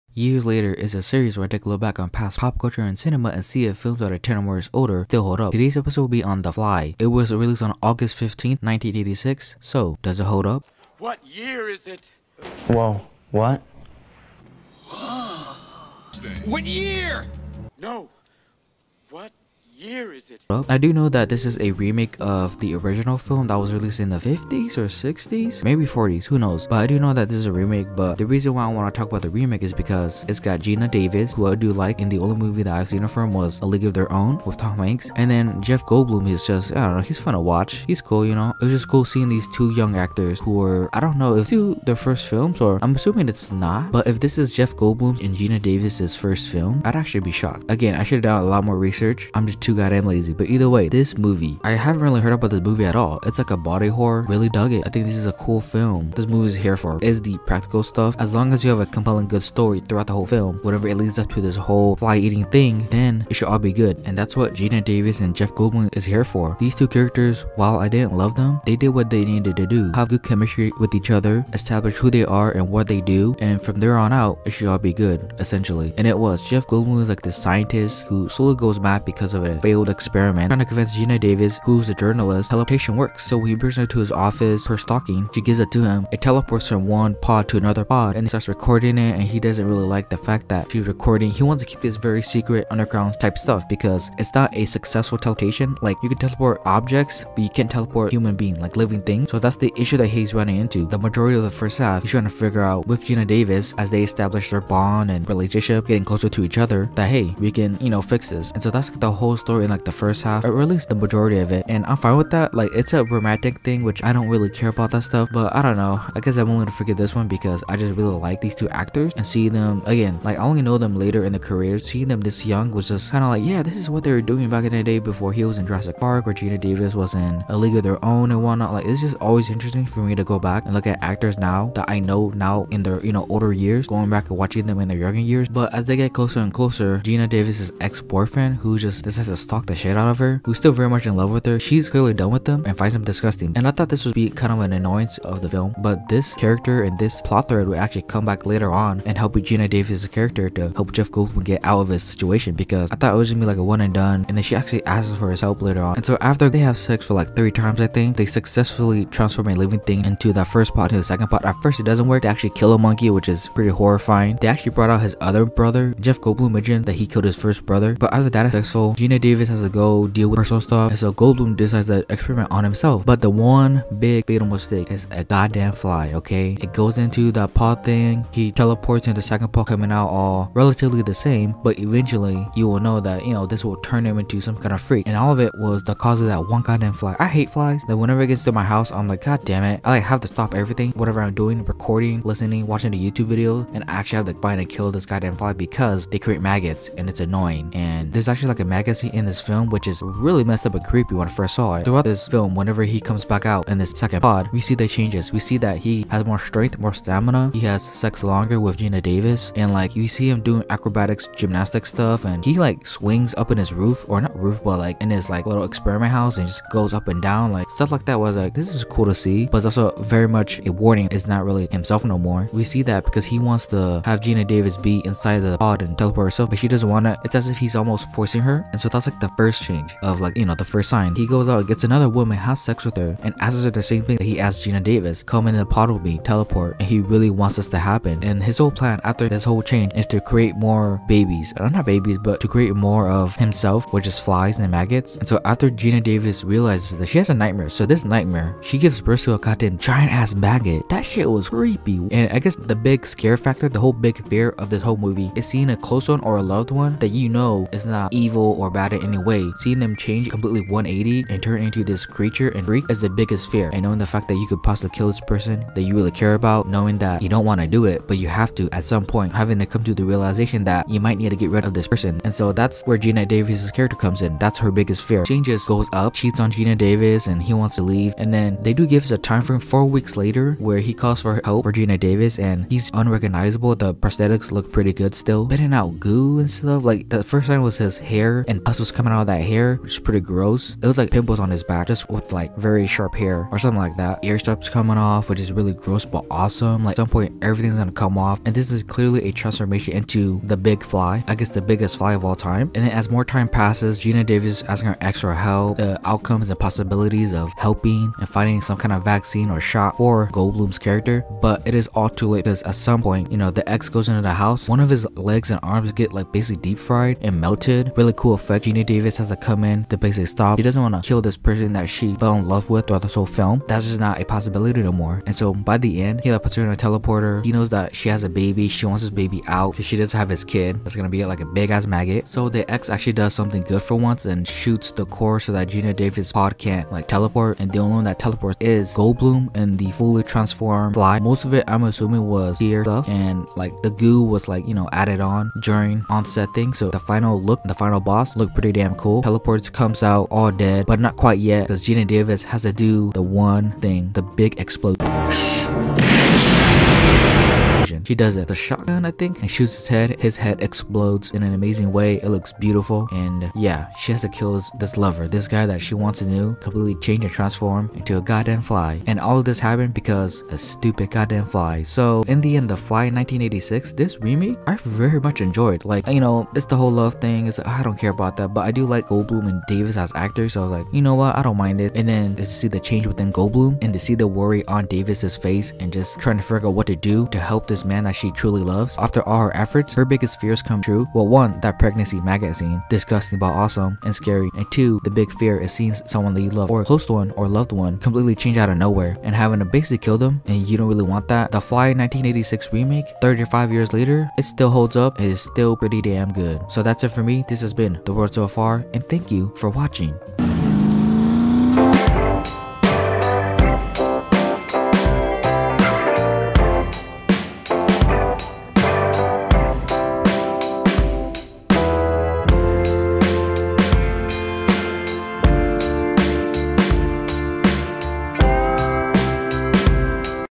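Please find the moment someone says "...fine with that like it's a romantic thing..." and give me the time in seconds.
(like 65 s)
111 s.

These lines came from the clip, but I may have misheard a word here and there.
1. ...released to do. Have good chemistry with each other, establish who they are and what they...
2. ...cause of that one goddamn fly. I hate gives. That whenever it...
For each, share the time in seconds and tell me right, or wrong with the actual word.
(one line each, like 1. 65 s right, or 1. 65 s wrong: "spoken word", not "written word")
1. 69 s wrong: "needed", not "released"
2. 185 s wrong: "flies", not "gives".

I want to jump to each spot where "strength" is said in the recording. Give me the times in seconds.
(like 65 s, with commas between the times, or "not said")
206 s.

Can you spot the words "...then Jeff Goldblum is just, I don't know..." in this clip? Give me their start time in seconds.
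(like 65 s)
35 s.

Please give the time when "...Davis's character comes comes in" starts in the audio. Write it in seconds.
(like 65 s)
273 s.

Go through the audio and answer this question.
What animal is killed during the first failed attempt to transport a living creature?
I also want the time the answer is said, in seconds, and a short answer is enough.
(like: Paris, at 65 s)
Monkey, at 162 s.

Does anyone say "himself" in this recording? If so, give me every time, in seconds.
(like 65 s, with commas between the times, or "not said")
172 s, 221 s, 243 s.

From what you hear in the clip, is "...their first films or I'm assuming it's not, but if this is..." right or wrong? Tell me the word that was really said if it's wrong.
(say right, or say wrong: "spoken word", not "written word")
right.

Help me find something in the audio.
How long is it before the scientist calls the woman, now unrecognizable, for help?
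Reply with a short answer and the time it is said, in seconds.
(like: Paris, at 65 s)
4 weeks, at 279 s.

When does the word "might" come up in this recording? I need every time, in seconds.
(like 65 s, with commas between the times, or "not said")
271 s.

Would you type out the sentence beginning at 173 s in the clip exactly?
But the one big fatal mistake is a goddamn fly, okay?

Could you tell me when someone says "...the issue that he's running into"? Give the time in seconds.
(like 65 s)
99 s.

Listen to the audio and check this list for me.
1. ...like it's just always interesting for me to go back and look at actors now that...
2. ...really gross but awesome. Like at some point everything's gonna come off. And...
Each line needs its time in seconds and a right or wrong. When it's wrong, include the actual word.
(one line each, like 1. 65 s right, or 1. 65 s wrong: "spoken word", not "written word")
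1. 128 s right
2. 295 s right.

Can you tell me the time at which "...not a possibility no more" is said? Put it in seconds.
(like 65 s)
323 s.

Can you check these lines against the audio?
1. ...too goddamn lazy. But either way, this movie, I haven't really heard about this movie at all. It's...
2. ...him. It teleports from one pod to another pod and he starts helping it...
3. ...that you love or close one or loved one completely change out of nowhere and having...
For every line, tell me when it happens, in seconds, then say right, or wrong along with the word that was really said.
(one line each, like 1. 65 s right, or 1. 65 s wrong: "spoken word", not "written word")
1. 49 s right
2. 85 s wrong: "recording", not "helping"
3. 396 s right.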